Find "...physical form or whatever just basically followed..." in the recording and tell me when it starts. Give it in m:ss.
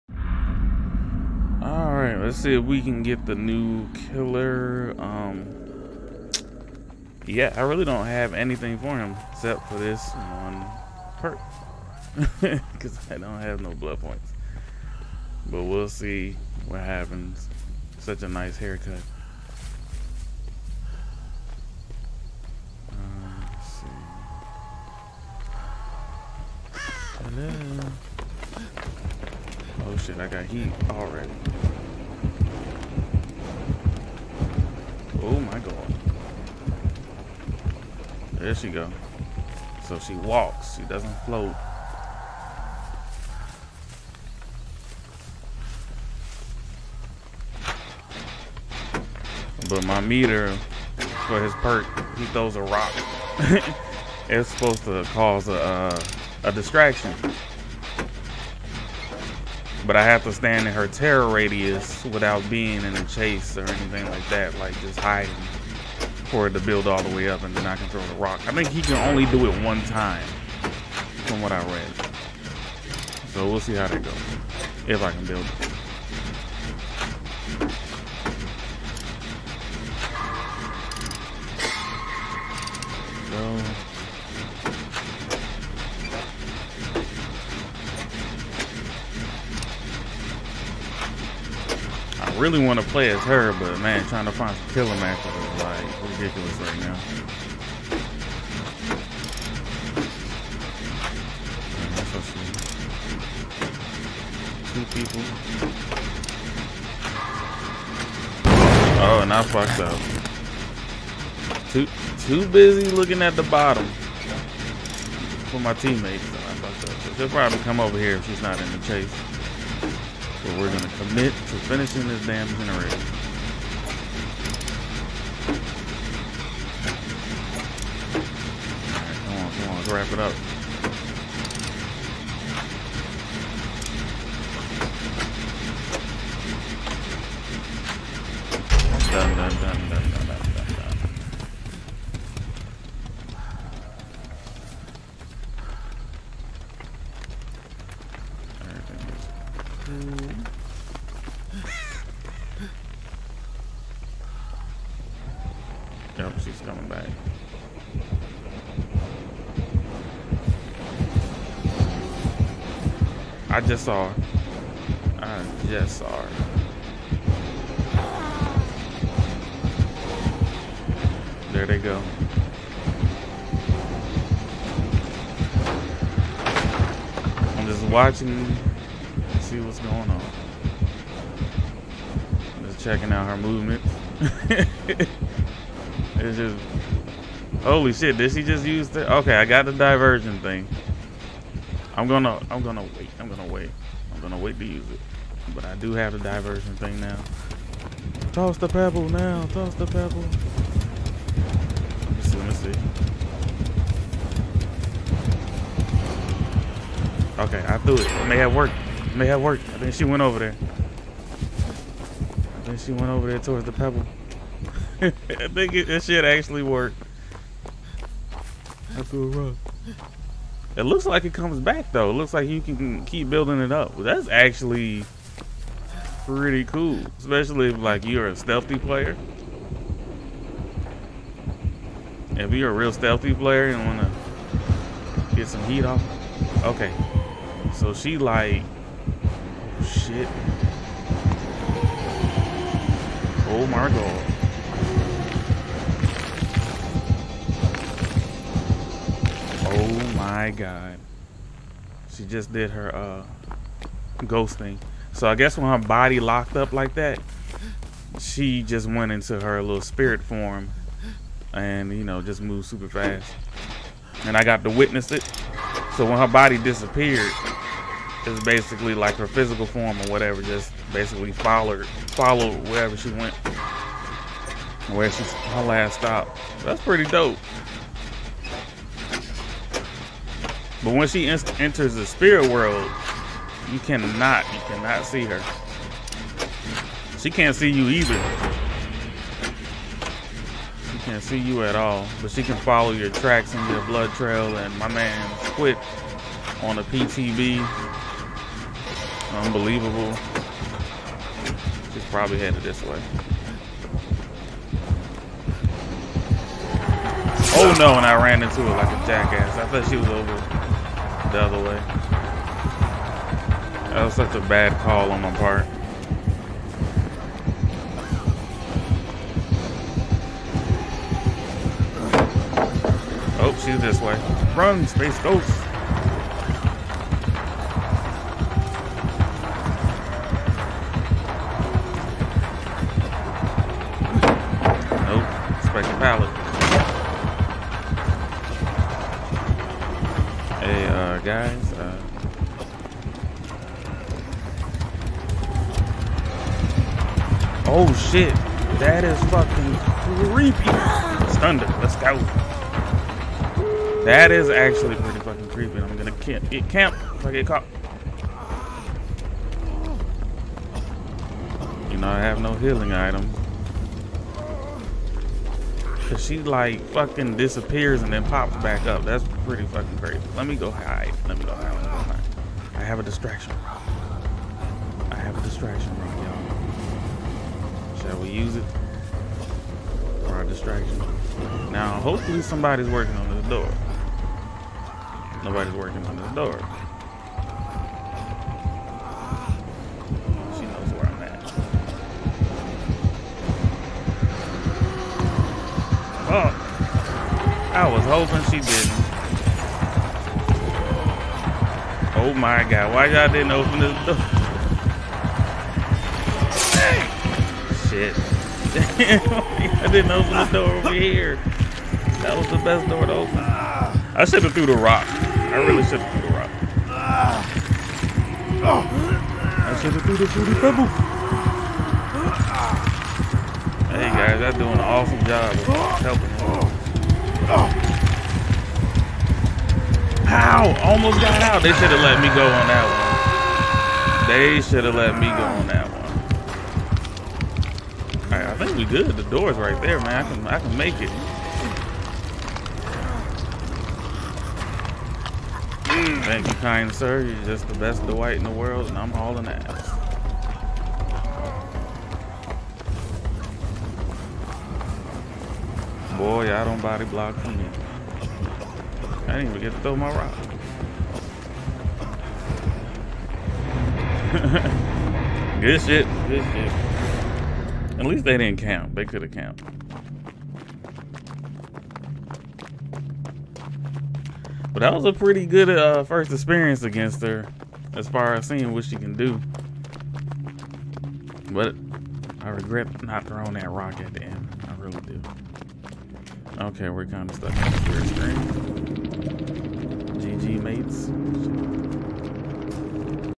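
4:29.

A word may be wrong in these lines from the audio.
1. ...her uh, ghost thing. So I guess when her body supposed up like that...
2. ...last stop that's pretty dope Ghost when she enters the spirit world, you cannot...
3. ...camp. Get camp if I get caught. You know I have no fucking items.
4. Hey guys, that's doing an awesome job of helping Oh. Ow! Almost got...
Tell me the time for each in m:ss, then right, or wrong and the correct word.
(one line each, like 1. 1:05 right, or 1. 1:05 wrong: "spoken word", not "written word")
1. 4:12 wrong: "locked", not "supposed"
2. 4:35 wrong: "But", not "Ghost"
3. 5:56 wrong: "healing", not "fucking"
4. 7:03 right.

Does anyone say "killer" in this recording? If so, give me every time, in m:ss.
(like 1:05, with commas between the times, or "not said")
0:03, 1:34.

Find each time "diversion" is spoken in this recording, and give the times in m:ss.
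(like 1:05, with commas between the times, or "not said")
3:09, 3:16.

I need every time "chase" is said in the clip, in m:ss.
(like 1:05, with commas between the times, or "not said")
1:03, 1:58.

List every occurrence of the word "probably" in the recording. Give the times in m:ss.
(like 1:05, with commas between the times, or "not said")
1:57, 5:02.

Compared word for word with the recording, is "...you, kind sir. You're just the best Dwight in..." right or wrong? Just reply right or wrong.
right.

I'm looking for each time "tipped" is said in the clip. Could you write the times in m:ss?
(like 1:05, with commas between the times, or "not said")
not said.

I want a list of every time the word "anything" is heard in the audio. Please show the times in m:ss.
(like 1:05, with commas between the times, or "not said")
0:08, 1:03.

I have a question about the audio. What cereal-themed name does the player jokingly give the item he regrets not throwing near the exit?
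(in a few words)
fruity pebble.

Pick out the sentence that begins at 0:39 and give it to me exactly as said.
So she walks, she doesn't float.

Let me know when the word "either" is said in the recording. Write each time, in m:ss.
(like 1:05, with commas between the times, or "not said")
4:47.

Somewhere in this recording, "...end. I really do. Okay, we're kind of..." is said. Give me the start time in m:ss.
8:04.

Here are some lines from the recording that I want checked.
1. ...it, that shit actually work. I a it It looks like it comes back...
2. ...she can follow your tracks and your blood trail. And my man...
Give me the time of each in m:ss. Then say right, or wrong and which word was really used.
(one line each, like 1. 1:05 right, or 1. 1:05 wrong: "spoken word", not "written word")
1. 3:35 right
2. 4:52 right.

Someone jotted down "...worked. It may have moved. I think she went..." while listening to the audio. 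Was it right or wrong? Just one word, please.
wrong.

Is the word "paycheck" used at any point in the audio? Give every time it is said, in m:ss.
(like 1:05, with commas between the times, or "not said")
not said.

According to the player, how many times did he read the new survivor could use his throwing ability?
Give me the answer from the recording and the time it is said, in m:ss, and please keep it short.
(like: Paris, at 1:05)
1, at 1:09.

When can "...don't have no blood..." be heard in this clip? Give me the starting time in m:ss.
0:13.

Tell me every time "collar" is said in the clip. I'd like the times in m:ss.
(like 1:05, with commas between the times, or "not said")
not said.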